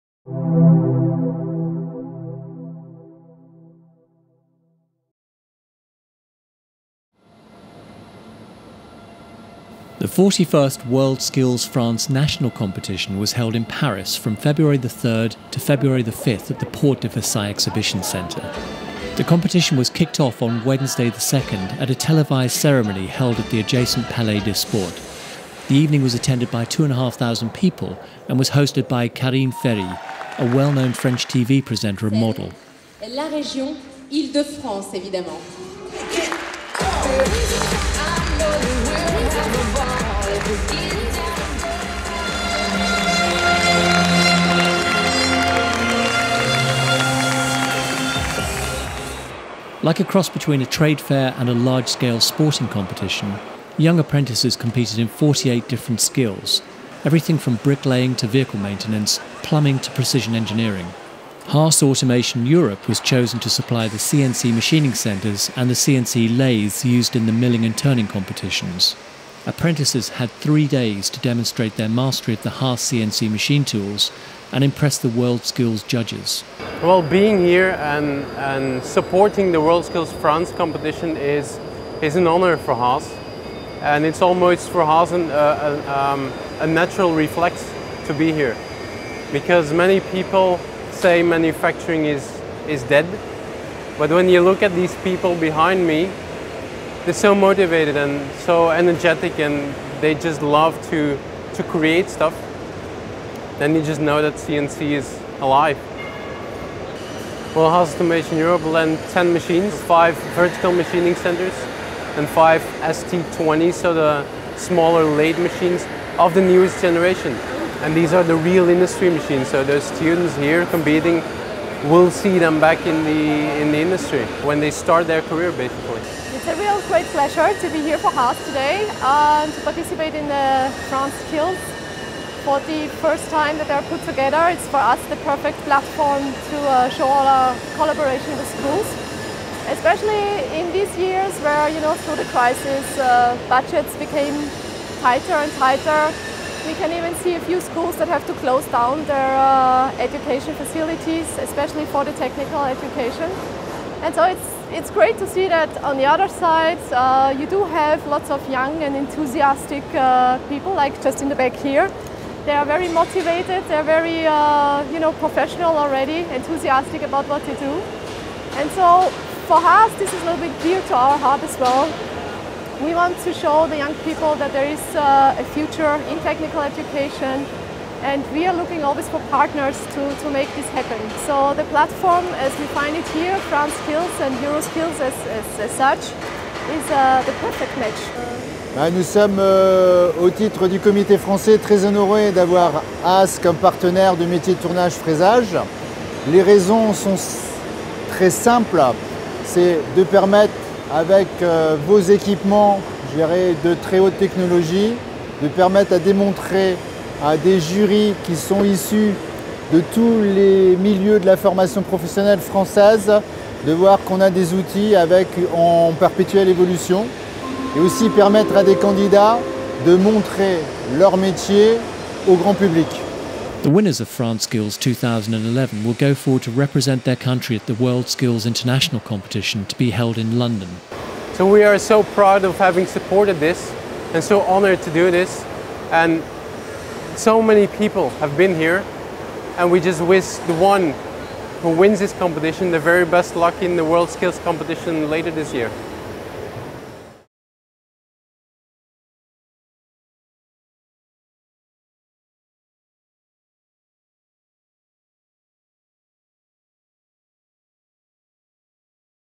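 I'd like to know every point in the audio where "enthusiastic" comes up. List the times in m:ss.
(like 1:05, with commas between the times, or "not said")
2:38, 2:46.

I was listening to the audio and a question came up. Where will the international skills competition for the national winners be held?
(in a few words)
London.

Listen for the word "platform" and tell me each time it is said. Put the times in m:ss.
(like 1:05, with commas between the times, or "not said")
2:15, 3:01.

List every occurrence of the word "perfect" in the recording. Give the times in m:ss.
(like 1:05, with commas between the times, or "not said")
2:15, 3:07.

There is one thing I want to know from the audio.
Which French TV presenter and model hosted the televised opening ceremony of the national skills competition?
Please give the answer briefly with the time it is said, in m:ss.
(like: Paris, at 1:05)
Karine Ferry, at 0:29.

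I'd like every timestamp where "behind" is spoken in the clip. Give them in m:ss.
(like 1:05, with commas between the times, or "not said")
1:35.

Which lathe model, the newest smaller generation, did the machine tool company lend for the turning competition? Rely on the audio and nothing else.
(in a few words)
ST20.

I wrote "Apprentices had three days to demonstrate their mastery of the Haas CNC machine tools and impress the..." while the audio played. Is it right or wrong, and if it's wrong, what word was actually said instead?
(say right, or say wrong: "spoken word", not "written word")
right.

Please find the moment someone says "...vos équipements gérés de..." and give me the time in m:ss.
3:21.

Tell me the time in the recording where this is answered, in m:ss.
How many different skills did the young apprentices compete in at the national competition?
0:55.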